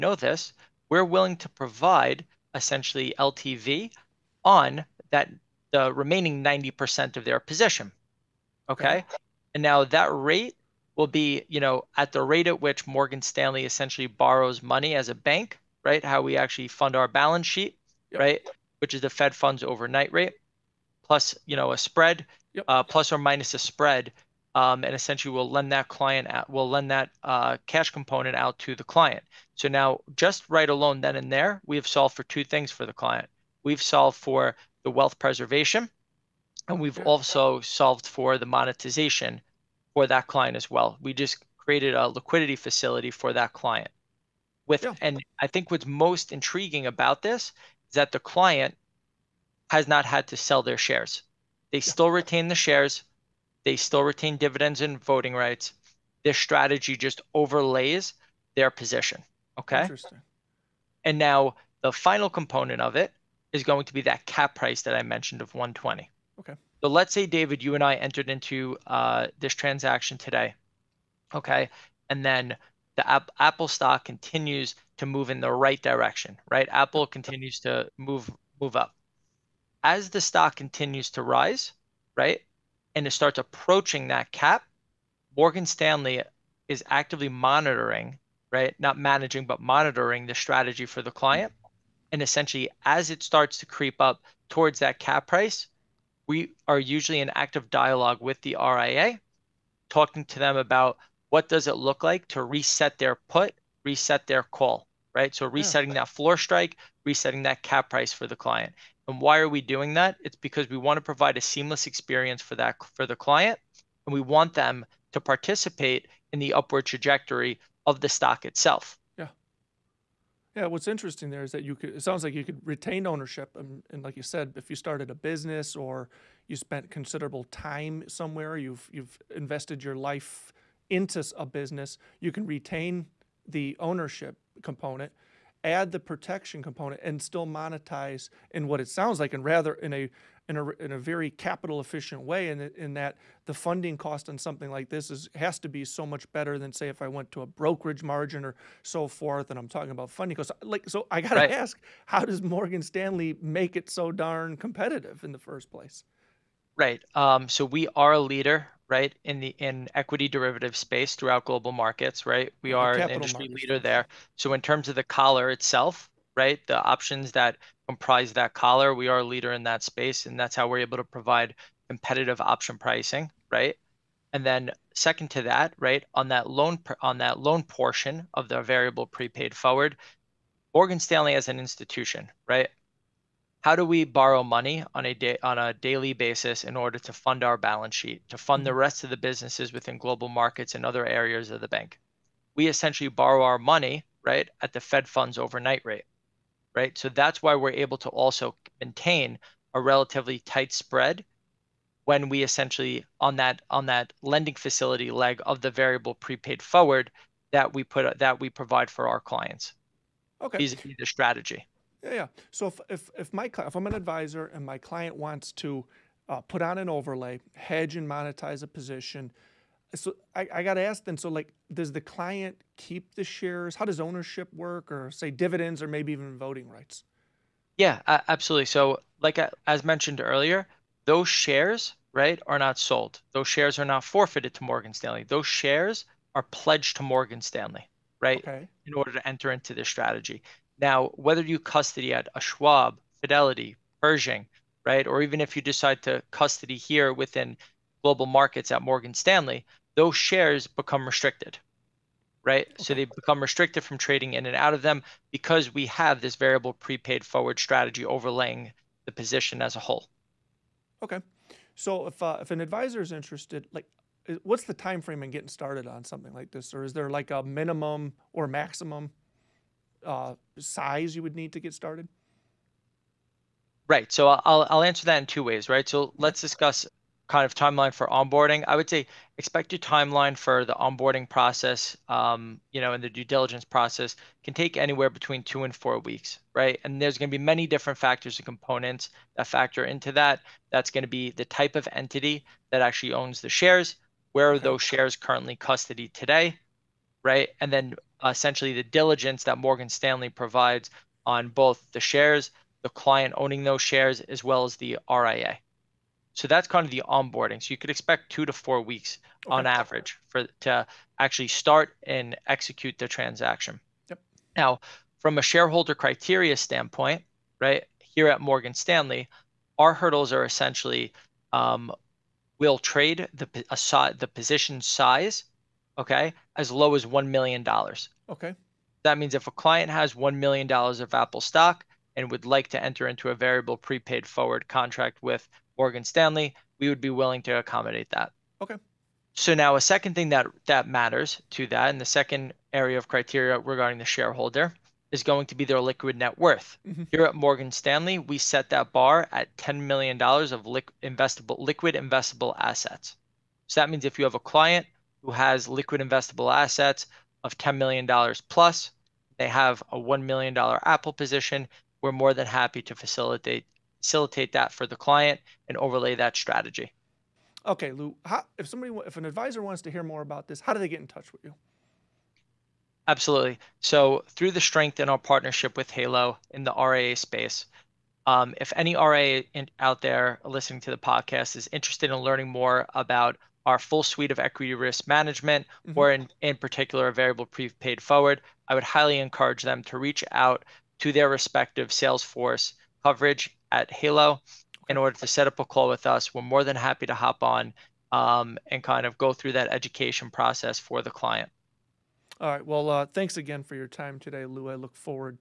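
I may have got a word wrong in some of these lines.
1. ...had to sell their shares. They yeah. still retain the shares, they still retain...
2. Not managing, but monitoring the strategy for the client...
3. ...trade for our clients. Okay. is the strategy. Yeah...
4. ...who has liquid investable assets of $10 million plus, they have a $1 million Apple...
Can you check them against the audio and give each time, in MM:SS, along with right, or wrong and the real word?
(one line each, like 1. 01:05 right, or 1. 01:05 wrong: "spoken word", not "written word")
1. 00:50 right
2. 01:28 right
3. 03:28 wrong: "provide", not "trade"
4. 05:55 right.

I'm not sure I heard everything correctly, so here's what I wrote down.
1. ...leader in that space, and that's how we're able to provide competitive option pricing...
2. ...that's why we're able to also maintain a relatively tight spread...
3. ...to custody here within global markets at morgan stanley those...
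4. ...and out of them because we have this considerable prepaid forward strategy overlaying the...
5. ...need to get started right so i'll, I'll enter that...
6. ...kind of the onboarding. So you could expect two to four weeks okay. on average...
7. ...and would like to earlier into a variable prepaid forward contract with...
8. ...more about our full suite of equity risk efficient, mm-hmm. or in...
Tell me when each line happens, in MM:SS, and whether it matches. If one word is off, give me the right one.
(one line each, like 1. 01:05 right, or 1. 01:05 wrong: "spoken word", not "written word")
1. 02:49 right
2. 03:17 right
3. 04:06 right
4. 04:14 wrong: "variable", not "considerable"
5. 04:31 wrong: "answer", not "enter"
6. 05:06 right
7. 05:32 wrong: "enter", not "earlier"
8. 06:22 wrong: "management", not "efficient".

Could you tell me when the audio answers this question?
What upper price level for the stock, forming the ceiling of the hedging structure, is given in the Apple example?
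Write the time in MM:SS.
01:05.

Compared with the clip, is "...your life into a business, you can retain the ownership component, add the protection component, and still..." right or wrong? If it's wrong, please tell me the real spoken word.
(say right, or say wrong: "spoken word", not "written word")
right.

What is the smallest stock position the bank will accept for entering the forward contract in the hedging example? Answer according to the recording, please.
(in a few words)
$1 million.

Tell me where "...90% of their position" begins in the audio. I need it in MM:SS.
00:06.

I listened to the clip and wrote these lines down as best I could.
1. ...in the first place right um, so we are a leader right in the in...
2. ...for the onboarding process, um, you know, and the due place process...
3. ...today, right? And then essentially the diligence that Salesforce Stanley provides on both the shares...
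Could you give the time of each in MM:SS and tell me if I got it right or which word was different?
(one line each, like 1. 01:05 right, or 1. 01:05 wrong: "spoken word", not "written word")
1. 02:35 right
2. 04:40 wrong: "diligence", not "place"
3. 04:56 wrong: "Morgan", not "Salesforce".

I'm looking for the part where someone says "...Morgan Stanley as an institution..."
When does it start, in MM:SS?
03:00.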